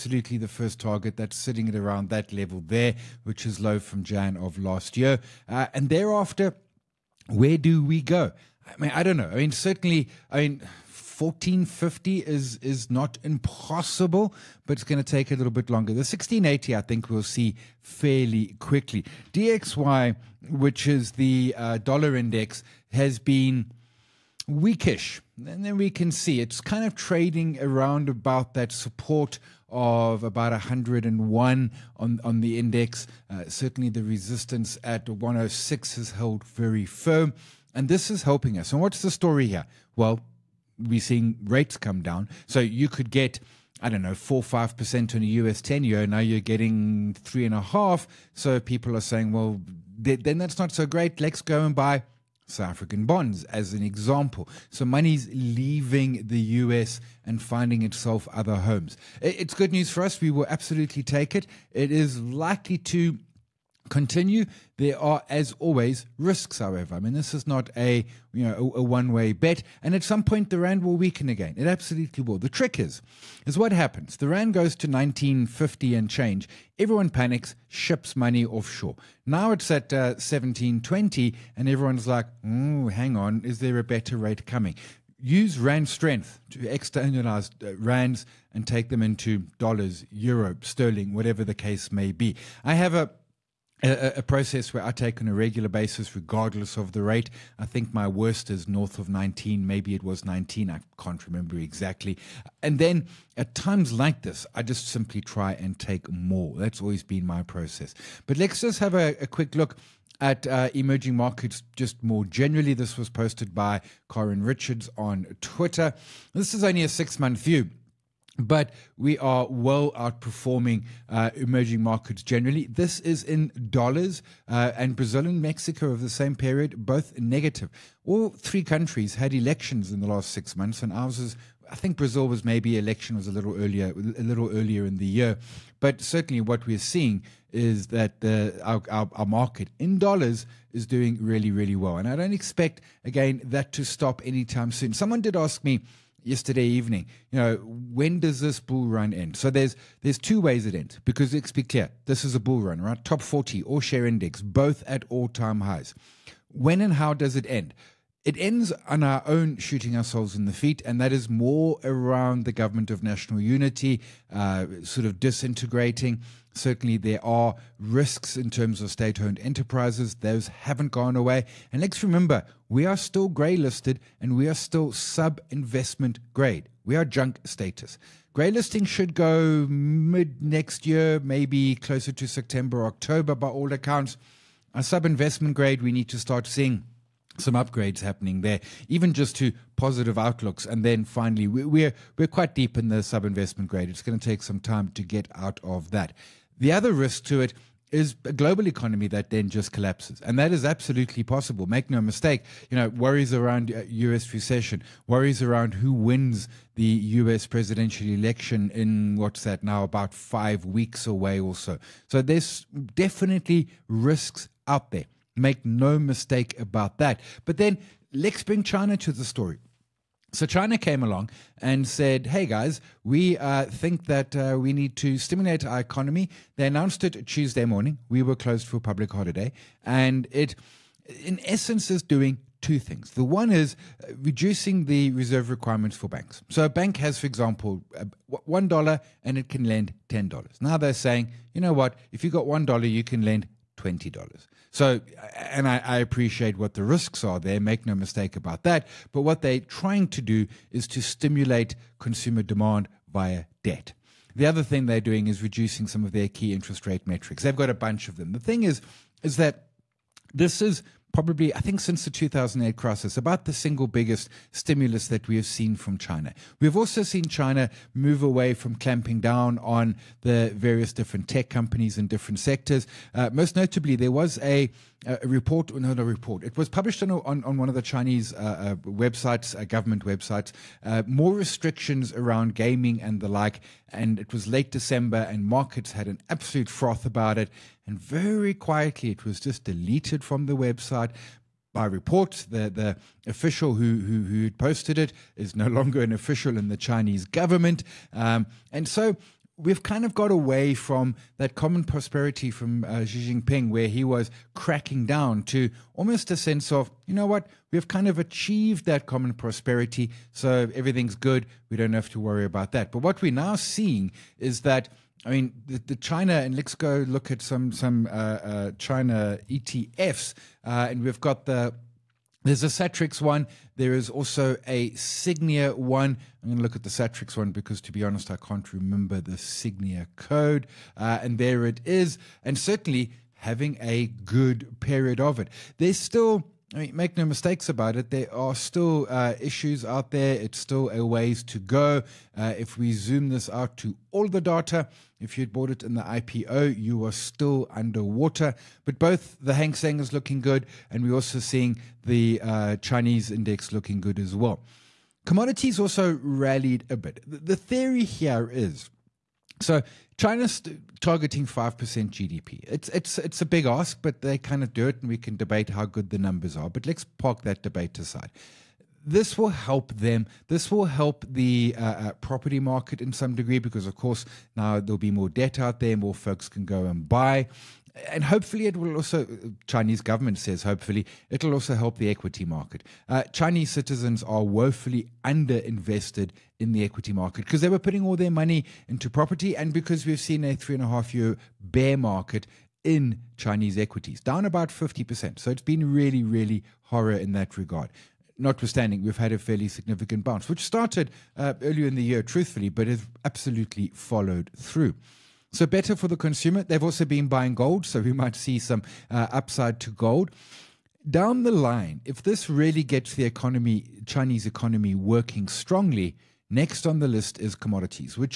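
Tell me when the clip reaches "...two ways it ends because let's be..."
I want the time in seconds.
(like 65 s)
150 s.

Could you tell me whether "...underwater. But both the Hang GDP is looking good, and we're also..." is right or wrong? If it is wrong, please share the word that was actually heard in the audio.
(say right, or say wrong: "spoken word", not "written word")
wrong: "Seng", not "GDP".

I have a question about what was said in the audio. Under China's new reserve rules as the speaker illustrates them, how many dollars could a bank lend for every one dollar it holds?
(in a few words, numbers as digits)
twenty dollars.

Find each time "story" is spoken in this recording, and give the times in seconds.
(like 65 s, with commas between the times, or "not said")
39 s, 219 s.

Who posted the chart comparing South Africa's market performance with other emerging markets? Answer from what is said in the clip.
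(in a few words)
Corin Richards.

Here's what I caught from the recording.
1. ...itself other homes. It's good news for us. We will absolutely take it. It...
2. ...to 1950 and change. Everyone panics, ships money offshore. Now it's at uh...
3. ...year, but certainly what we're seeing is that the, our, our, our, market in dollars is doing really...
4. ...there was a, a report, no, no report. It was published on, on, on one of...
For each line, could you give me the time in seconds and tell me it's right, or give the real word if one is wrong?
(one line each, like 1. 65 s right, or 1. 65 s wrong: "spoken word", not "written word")
1. 57 s right
2. 74 s right
3. 135 s right
4. 273 s right.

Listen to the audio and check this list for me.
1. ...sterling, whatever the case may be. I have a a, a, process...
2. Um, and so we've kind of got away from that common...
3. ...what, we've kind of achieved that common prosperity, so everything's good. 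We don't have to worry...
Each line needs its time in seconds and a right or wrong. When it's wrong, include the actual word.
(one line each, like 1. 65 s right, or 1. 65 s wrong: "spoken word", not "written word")
1. 90 s right
2. 298 s right
3. 307 s right.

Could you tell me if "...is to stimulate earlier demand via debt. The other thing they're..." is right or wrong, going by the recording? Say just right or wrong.
wrong.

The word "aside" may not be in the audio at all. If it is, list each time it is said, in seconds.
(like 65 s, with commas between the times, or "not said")
367 s.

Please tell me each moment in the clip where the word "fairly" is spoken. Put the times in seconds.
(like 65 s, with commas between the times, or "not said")
17 s, 399 s.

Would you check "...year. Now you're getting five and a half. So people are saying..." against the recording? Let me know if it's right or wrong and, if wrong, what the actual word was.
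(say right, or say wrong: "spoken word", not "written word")
wrong: "three", not "five".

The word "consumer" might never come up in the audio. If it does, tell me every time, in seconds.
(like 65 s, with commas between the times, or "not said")
251 s, 406 s.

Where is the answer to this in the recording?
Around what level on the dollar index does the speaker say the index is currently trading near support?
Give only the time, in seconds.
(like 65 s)
30 s.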